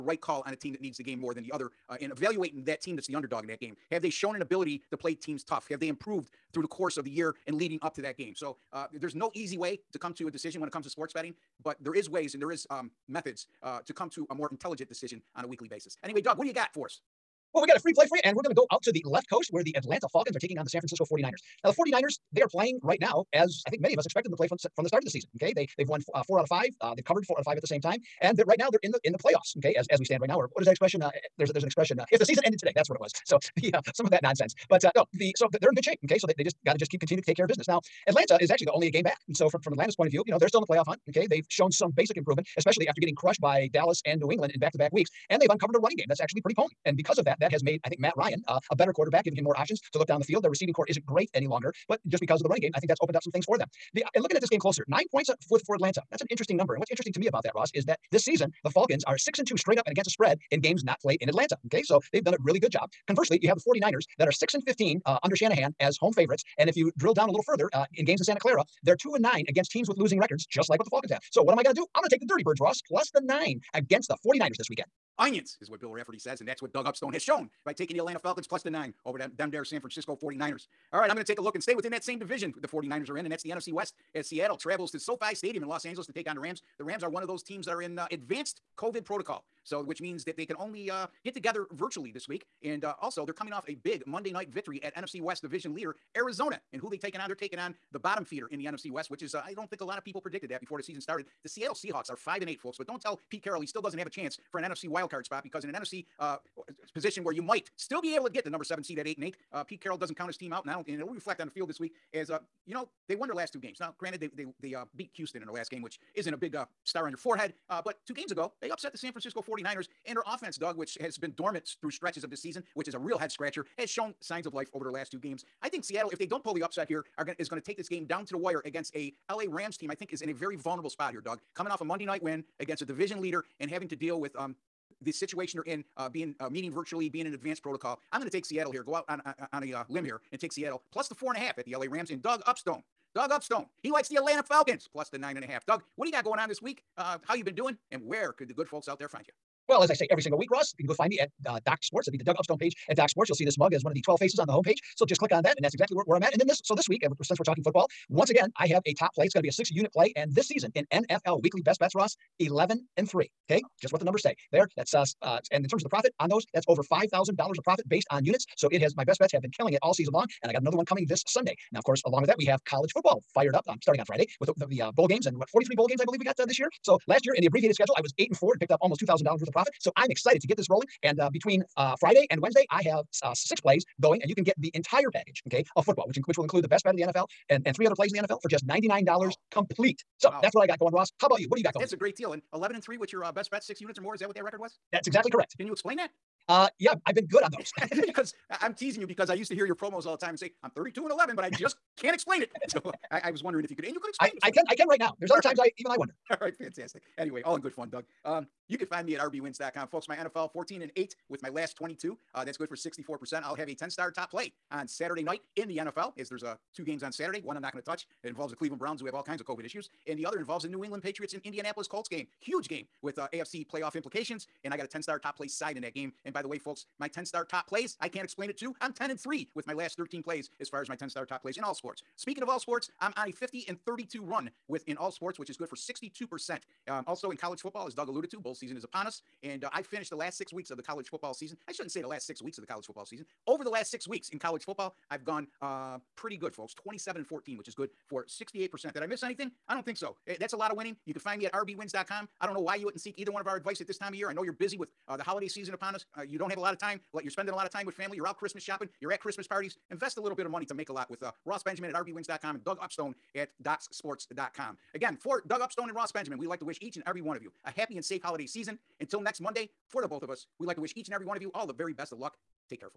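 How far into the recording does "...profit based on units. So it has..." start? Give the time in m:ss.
2:47.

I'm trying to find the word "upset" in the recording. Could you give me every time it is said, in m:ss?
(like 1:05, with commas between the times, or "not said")
1:58, 2:06.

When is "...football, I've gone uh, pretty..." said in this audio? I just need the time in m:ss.
4:04.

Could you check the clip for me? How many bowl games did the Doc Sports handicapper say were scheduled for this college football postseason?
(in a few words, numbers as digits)
43.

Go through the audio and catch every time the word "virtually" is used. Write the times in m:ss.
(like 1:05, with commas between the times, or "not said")
1:31, 2:16.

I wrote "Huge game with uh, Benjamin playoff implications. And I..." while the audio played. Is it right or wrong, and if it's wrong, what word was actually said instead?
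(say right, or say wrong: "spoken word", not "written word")
wrong: "AFC", not "Benjamin".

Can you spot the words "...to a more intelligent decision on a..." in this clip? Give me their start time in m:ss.
0:14.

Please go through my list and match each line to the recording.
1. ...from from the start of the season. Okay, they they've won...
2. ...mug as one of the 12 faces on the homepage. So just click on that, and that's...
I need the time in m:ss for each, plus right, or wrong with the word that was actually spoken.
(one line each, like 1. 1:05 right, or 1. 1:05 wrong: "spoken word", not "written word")
1. 0:24 right
2. 2:33 right.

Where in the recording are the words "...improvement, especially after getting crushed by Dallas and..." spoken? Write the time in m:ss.
0:42.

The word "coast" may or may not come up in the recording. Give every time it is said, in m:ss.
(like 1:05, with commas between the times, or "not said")
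0:19.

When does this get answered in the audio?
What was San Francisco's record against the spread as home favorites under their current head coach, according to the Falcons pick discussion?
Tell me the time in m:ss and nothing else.
1:04.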